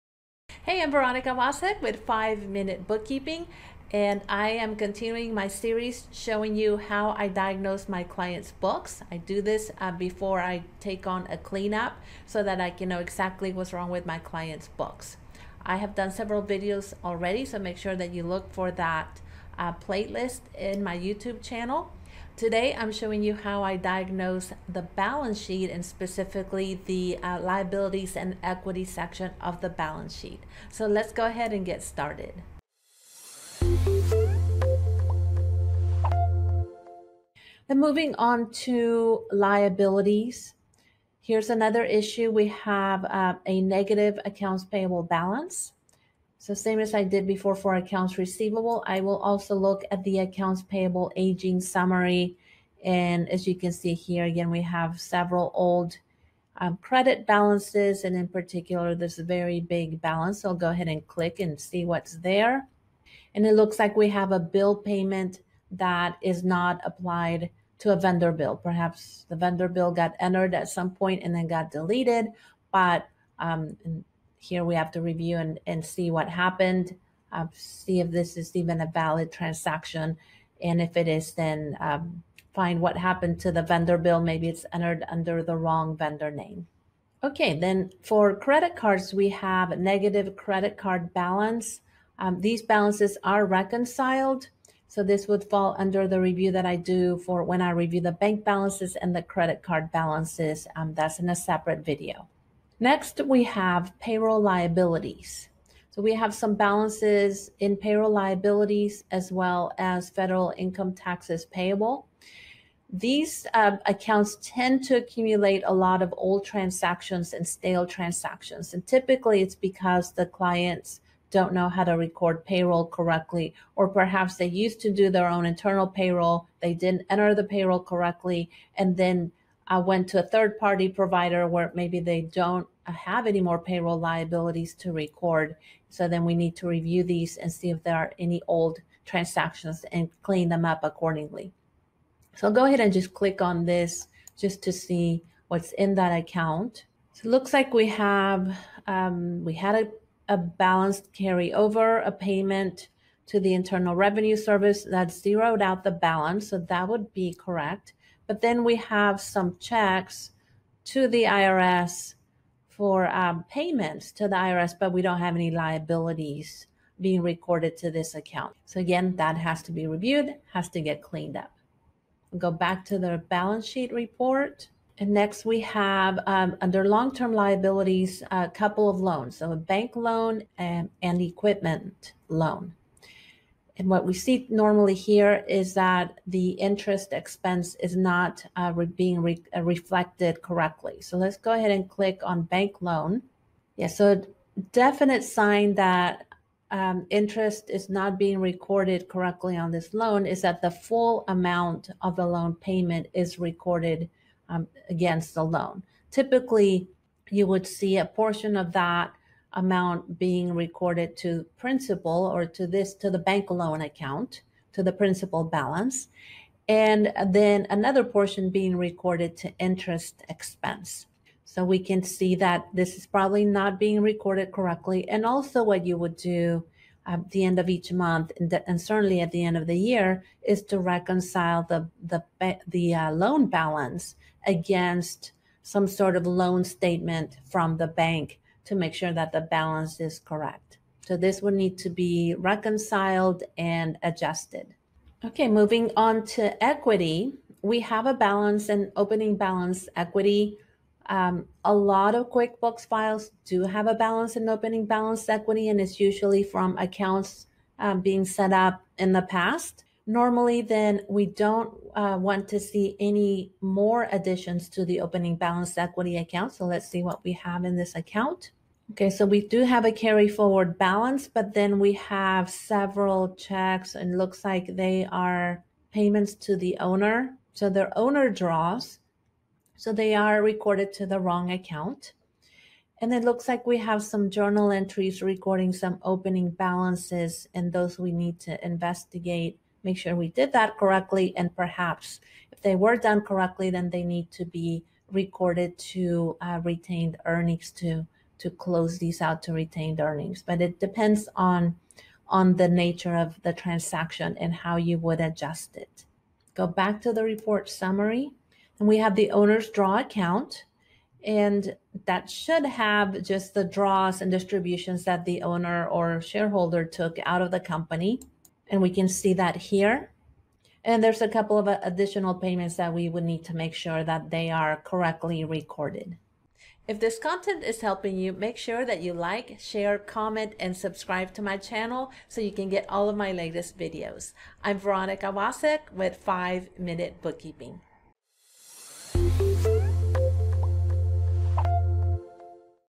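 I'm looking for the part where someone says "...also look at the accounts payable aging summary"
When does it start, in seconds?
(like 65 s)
49 s.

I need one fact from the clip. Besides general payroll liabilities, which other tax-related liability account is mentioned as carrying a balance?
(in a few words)
Federal income taxes payable.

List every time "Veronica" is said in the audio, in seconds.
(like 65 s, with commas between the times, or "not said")
0 s, 334 s.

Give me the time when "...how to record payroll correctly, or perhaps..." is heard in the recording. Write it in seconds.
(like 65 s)
121 s.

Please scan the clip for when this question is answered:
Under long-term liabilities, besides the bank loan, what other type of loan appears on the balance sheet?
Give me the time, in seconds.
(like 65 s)
181 s.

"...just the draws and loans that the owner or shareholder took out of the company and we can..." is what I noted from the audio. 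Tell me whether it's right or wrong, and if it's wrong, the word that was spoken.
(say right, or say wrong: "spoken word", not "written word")
wrong: "distributions", not "loans".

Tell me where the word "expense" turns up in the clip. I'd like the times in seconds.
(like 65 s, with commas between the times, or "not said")
187 s, 220 s.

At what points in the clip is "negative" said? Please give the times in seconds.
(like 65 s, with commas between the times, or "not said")
43 s, 89 s.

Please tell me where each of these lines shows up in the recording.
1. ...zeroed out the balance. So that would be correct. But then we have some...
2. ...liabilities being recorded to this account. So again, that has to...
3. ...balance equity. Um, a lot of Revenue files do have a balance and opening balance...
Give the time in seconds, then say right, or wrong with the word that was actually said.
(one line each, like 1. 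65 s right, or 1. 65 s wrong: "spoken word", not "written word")
1. 155 s right
2. 165 s right
3. 249 s wrong: "QuickBooks", not "Revenue".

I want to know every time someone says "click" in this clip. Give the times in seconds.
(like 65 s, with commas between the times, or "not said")
61 s, 143 s, 191 s.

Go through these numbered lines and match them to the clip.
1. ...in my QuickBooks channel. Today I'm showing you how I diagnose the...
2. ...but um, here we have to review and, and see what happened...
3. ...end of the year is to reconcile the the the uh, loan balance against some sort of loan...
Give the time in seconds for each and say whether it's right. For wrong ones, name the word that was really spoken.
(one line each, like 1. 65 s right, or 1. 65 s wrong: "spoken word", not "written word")
1. 20 s wrong: "YouTube", not "QuickBooks"
2. 72 s right
3. 229 s right.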